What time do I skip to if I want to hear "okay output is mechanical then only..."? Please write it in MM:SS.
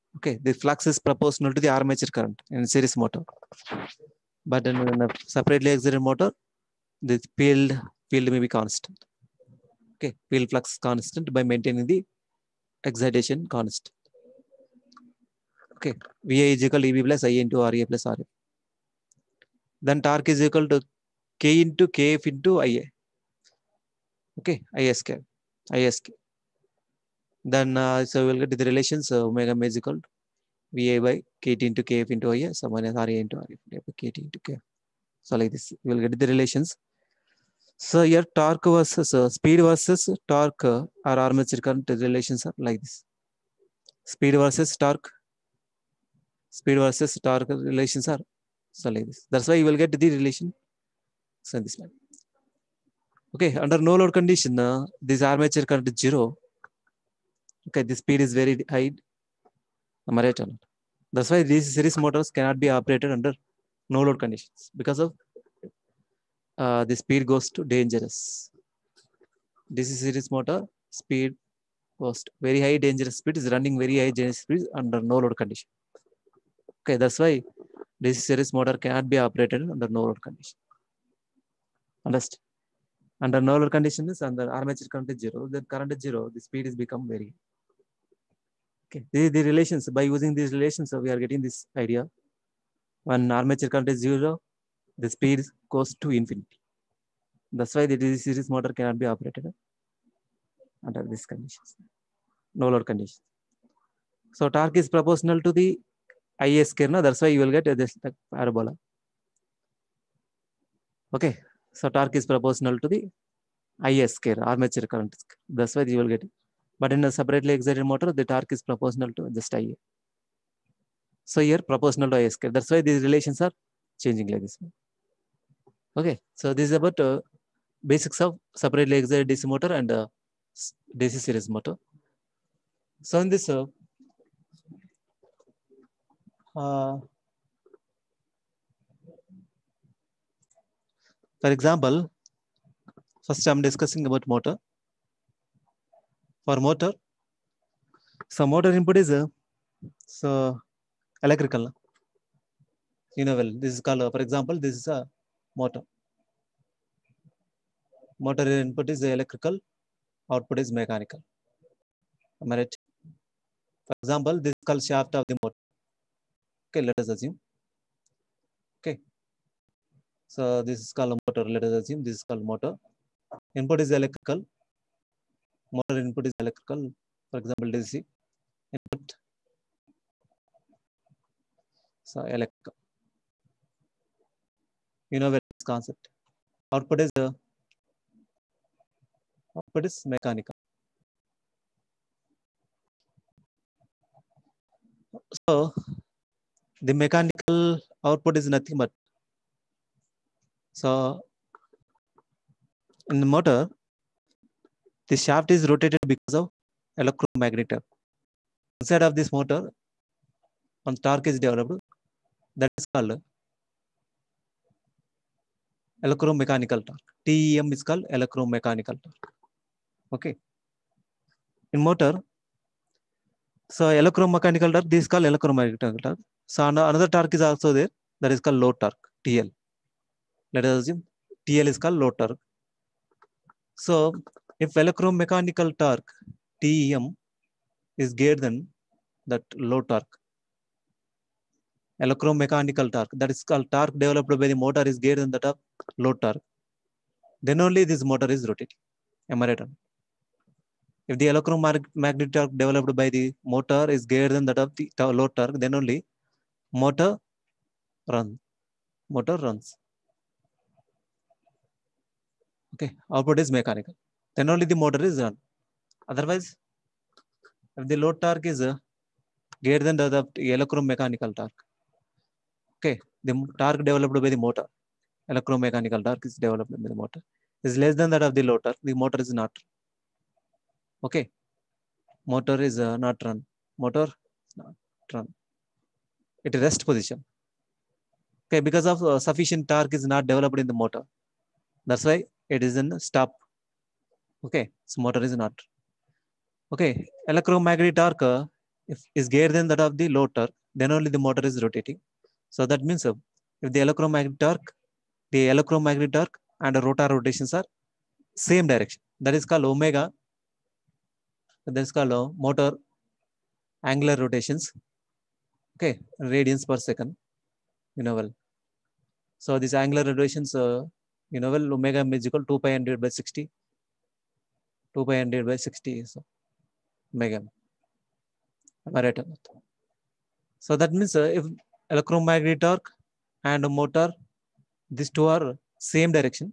04:22.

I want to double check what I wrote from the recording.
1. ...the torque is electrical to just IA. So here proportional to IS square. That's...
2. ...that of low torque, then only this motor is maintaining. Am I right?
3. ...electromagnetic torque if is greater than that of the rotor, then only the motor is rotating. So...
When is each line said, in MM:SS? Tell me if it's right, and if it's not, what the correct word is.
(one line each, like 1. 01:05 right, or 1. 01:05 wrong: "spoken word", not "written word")
1. 01:58 wrong: "proportional", not "electrical"
2. 04:05 wrong: "rotating", not "maintaining"
3. 04:57 right.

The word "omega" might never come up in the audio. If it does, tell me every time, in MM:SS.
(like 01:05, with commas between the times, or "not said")
00:29, 05:09, 05:21, 05:27.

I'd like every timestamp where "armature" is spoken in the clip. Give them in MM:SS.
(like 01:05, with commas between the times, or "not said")
00:01, 00:41, 00:55, 01:24, 01:33, 01:54.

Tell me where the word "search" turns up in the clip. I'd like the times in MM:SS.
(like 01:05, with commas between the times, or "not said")
not said.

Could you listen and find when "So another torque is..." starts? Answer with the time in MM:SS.
03:46.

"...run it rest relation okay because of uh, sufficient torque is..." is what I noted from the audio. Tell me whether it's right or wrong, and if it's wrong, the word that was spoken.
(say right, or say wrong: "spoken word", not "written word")
wrong: "position", not "relation".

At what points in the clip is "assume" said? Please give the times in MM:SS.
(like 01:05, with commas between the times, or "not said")
02:47, 02:51, 03:50.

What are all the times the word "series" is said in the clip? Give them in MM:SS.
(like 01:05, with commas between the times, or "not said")
00:02, 01:01, 01:10, 01:18, 01:38, 02:11.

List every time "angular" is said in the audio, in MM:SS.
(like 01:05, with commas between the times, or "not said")
05:13, 05:19.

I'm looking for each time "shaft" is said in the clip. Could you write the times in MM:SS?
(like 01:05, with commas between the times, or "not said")
02:44, 03:25.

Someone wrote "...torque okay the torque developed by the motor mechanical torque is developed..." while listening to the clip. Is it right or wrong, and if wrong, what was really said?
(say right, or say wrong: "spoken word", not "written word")
right.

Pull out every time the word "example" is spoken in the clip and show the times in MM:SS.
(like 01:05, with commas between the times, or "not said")
02:21, 02:34, 02:44, 02:57.